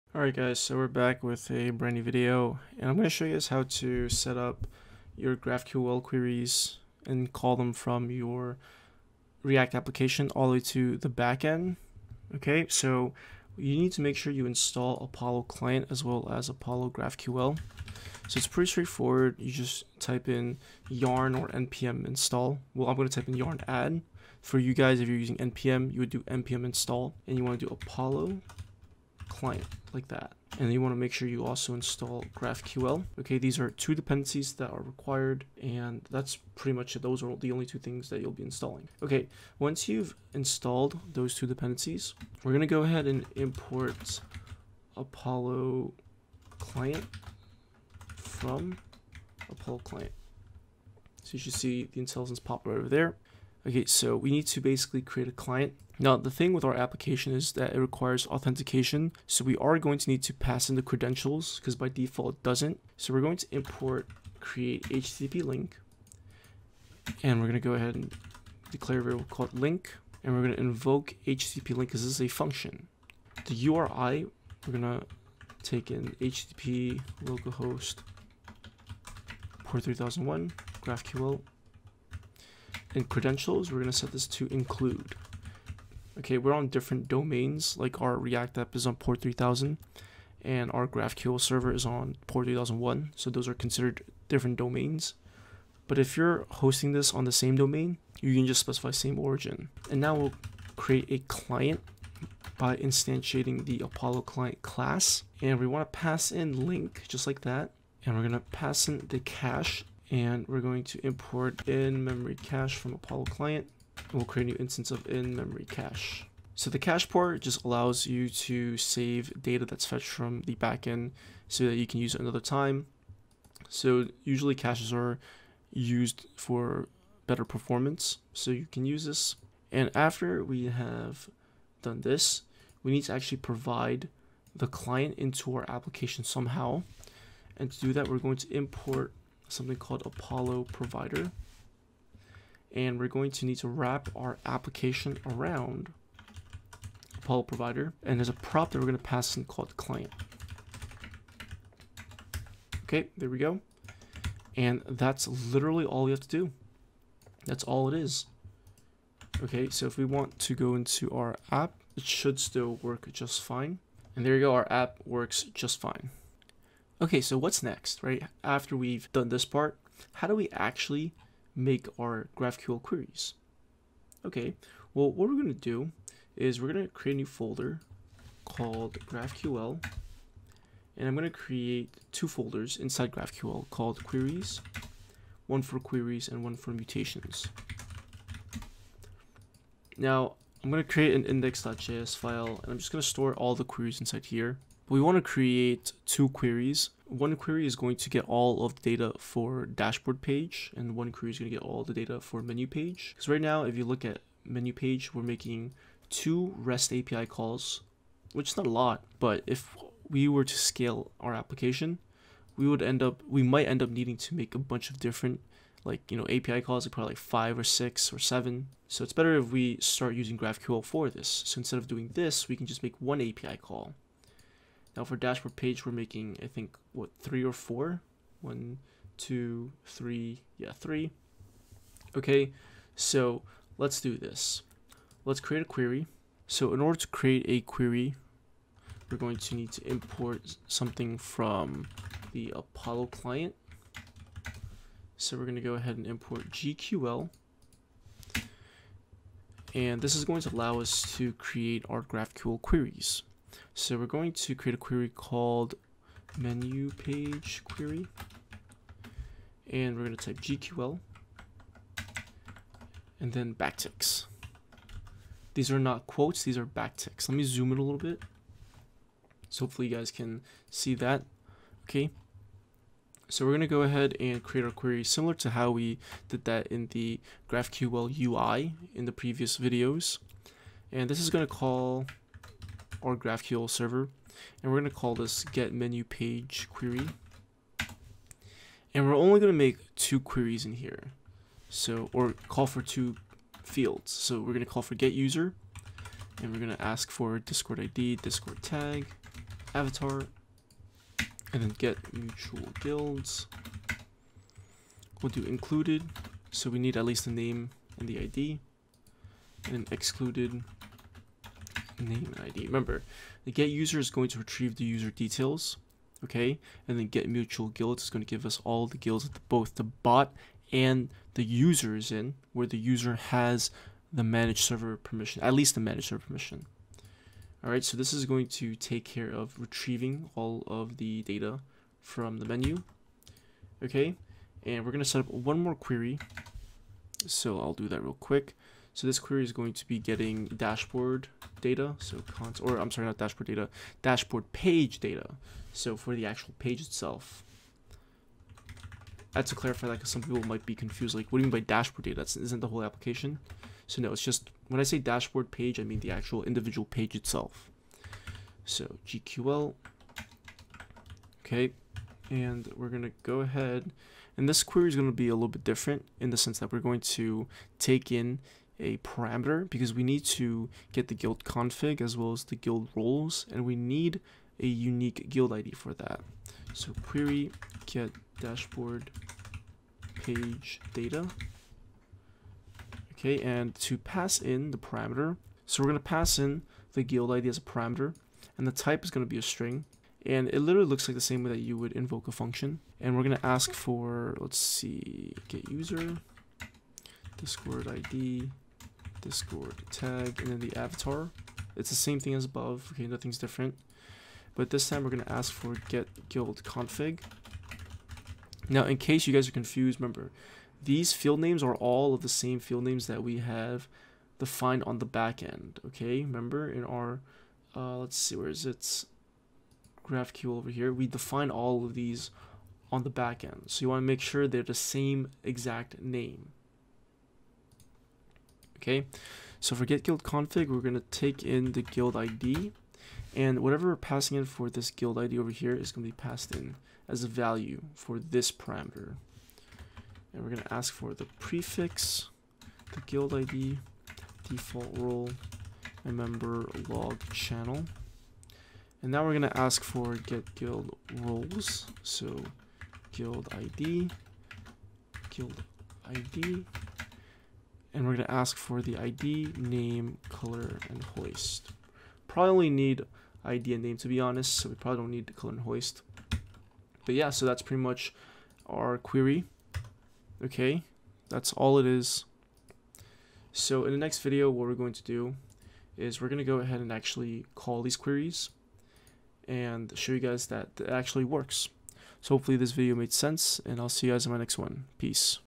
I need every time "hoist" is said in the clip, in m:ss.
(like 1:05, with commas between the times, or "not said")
7:41, 7:45.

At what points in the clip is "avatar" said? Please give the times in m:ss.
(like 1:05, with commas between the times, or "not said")
4:59, 6:40.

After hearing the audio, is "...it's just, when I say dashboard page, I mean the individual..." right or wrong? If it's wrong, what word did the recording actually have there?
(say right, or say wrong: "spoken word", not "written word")
wrong: "actual", not "individual".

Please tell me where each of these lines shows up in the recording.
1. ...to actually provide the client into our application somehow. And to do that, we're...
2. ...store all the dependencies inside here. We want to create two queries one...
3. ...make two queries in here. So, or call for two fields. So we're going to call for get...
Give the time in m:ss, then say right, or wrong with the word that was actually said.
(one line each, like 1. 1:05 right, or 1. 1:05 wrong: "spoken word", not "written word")
1. 2:13 right
2. 3:13 wrong: "queries", not "dependencies"
3. 4:49 right.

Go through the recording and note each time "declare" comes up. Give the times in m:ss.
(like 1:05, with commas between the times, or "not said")
1:08.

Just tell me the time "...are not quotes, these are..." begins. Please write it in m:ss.
4:25.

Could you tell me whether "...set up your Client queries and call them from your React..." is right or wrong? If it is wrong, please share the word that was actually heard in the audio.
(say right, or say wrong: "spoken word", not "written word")
wrong: "GraphQL", not "Client".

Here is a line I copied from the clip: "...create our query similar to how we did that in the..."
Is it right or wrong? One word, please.
right.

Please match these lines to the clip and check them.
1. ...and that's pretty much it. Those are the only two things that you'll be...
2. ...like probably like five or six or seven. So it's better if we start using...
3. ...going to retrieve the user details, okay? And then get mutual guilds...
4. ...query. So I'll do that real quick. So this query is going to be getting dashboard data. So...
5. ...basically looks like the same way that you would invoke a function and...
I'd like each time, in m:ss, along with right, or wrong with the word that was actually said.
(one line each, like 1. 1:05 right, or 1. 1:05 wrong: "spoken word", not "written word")
1. 0:35 right
2. 3:36 right
3. 5:14 right
4. 5:35 right
5. 6:30 wrong: "literally", not "basically".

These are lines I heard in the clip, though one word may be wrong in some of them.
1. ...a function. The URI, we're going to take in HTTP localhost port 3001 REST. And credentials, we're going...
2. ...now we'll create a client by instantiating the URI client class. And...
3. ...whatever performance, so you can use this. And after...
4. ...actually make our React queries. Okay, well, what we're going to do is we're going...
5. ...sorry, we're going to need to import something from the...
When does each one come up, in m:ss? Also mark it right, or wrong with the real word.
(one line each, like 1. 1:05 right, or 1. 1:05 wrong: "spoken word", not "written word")
1. 1:12 wrong: "GraphQL", not "REST"
2. 1:40 wrong: "Apollo", not "URI"
3. 2:07 wrong: "better", not "whatever"
4. 2:50 wrong: "GraphQL", not "React"
5. 3:57 wrong: "query", not "sorry".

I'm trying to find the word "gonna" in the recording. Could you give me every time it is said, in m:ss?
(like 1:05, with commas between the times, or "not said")
5:34, 6:45.